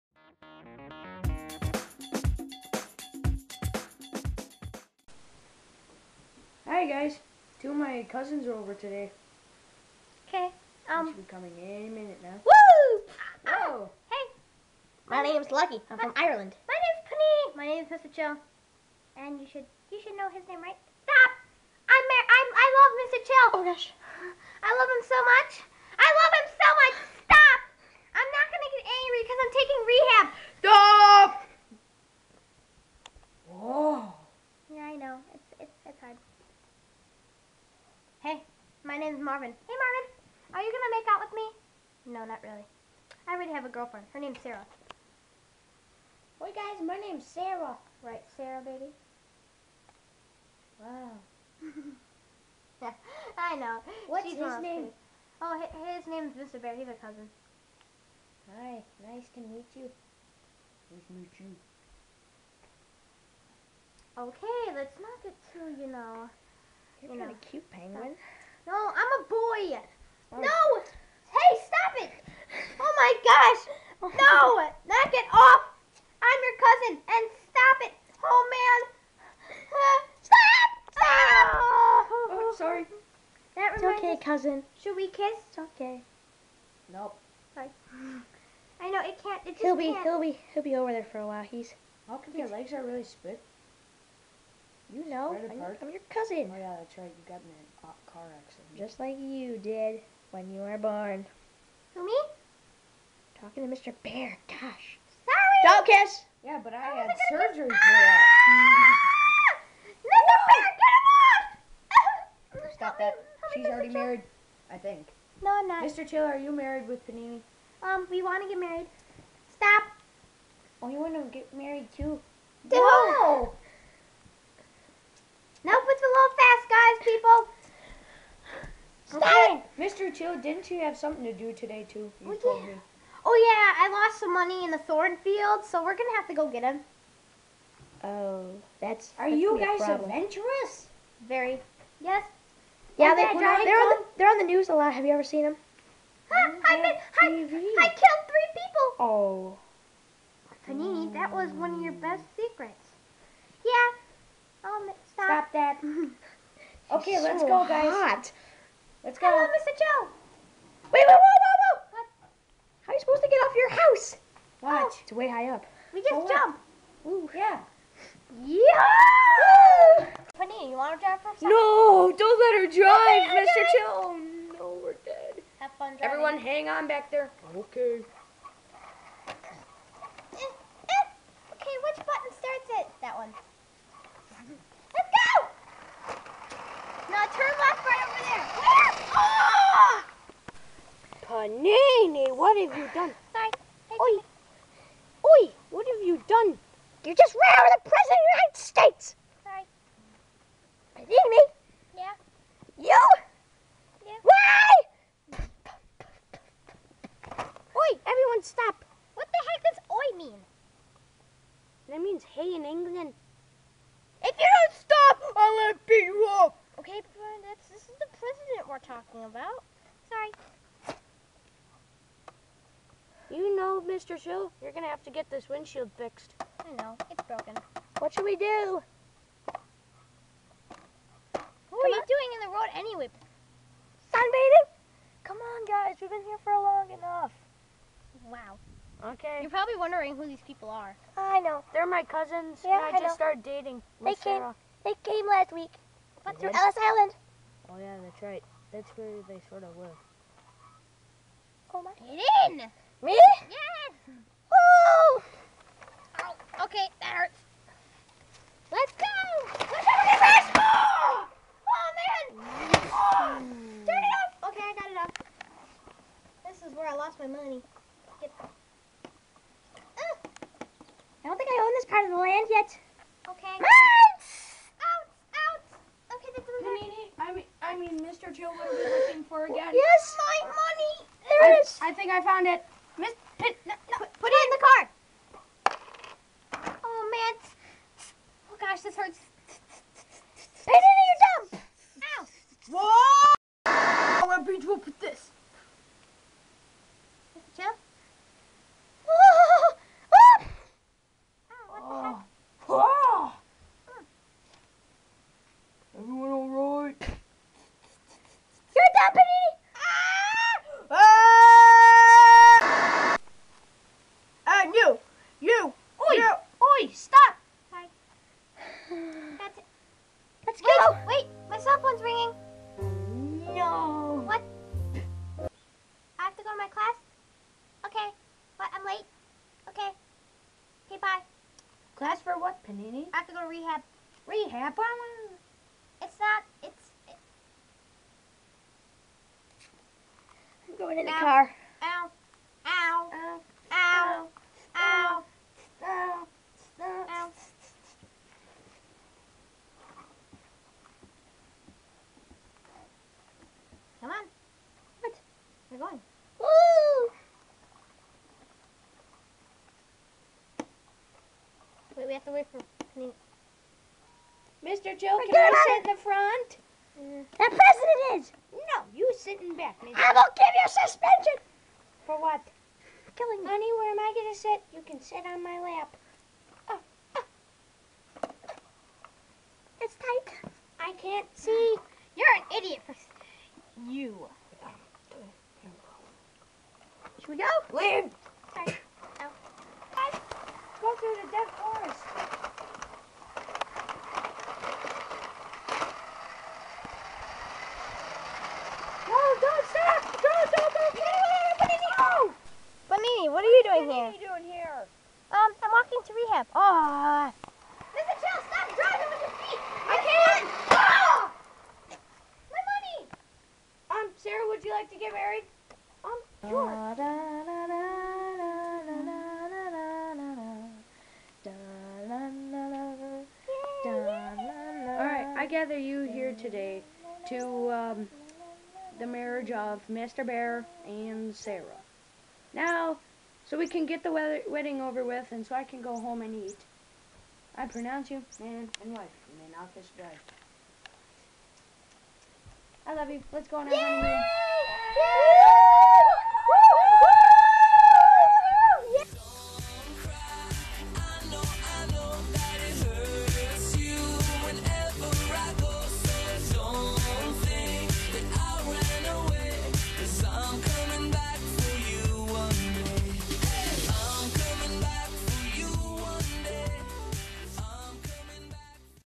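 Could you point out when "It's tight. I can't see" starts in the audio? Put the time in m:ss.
6:19.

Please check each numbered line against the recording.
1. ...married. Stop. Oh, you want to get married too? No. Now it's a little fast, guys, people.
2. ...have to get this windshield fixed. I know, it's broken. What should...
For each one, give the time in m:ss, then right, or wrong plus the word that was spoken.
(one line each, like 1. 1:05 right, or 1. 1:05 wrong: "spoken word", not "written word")
1. 1:58 right
2. 3:44 right.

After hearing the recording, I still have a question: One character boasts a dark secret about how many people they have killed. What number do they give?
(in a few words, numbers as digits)
3.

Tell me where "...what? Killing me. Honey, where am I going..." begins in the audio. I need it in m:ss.
6:12.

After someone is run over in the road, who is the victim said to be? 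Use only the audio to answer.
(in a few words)
President of the United States.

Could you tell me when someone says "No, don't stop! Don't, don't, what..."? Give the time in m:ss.
6:39.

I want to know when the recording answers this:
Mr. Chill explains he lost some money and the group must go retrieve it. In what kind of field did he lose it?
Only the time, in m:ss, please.
2:14.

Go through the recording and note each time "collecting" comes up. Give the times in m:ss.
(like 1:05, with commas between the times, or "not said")
not said.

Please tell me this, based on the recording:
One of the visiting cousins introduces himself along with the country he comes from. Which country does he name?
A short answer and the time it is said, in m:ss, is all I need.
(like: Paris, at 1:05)
Ireland, at 0:16.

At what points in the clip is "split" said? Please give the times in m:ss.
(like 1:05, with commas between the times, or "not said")
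1:33.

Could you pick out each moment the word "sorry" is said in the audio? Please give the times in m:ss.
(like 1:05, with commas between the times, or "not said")
1:22, 1:27, 1:45, 6:28.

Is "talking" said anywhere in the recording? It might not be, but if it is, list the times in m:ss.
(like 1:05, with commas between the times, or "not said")
1:43, 3:38.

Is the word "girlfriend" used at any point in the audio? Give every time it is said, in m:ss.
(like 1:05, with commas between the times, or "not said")
0:43.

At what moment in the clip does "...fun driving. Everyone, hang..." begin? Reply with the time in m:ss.
2:55.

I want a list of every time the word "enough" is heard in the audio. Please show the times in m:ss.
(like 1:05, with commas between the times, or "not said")
3:56.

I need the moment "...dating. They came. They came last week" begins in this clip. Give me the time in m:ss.
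4:03.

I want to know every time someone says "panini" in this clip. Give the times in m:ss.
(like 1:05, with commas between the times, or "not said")
1:57, 2:30, 2:50, 5:32.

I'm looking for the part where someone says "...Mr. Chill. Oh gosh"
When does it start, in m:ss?
0:23.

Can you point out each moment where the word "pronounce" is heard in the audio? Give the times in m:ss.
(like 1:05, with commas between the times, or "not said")
7:17.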